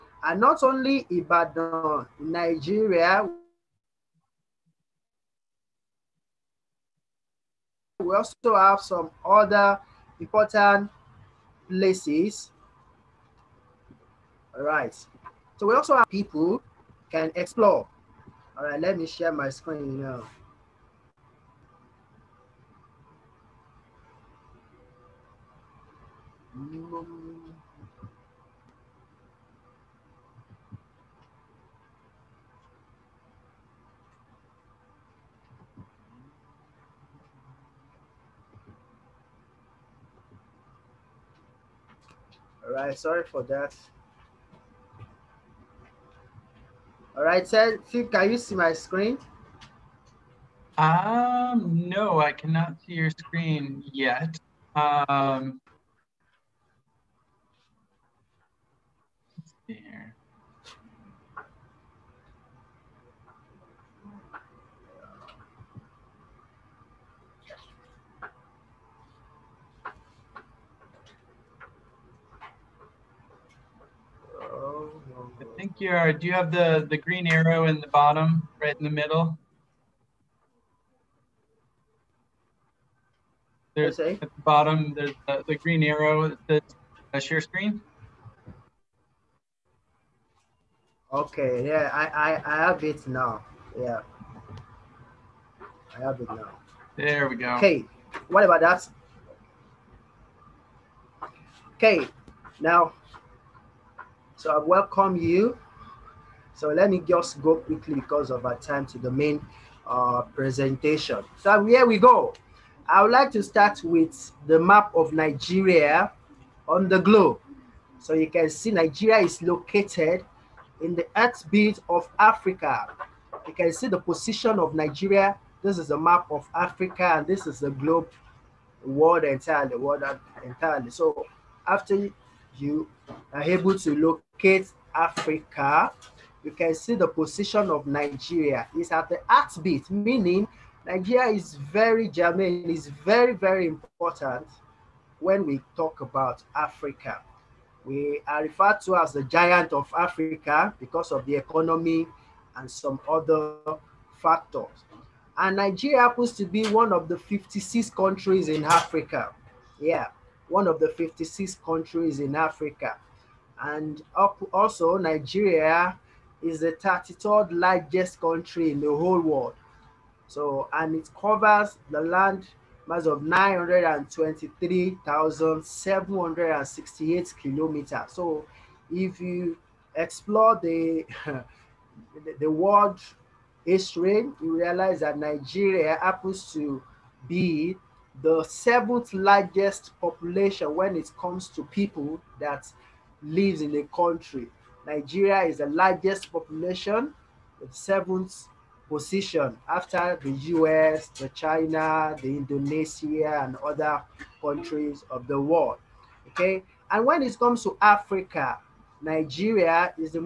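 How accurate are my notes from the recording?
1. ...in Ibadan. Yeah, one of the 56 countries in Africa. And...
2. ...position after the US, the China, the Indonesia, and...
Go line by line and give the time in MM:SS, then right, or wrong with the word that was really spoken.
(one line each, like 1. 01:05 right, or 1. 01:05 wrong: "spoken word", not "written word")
1. 02:38 wrong: "Africa", not "Ibadan"
2. 03:18 right.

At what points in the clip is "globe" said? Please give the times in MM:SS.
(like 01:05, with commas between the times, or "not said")
01:56, 02:07.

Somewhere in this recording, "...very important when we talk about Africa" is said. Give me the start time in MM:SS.
02:23.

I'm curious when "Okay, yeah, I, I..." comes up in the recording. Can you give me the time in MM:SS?
01:31.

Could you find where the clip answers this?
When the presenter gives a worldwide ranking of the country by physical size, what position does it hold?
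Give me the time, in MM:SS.
02:46.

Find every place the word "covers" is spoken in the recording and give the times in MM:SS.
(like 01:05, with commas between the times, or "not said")
02:51.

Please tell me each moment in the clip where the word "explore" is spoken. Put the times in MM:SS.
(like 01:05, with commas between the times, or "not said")
00:17, 02:59.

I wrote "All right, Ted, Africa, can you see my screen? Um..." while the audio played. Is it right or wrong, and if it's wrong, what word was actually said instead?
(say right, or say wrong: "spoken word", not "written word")
wrong: "Phil", not "Africa".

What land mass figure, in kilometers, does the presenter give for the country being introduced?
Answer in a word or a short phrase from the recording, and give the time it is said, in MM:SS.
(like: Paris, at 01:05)
923,768 kilometers, at 02:53.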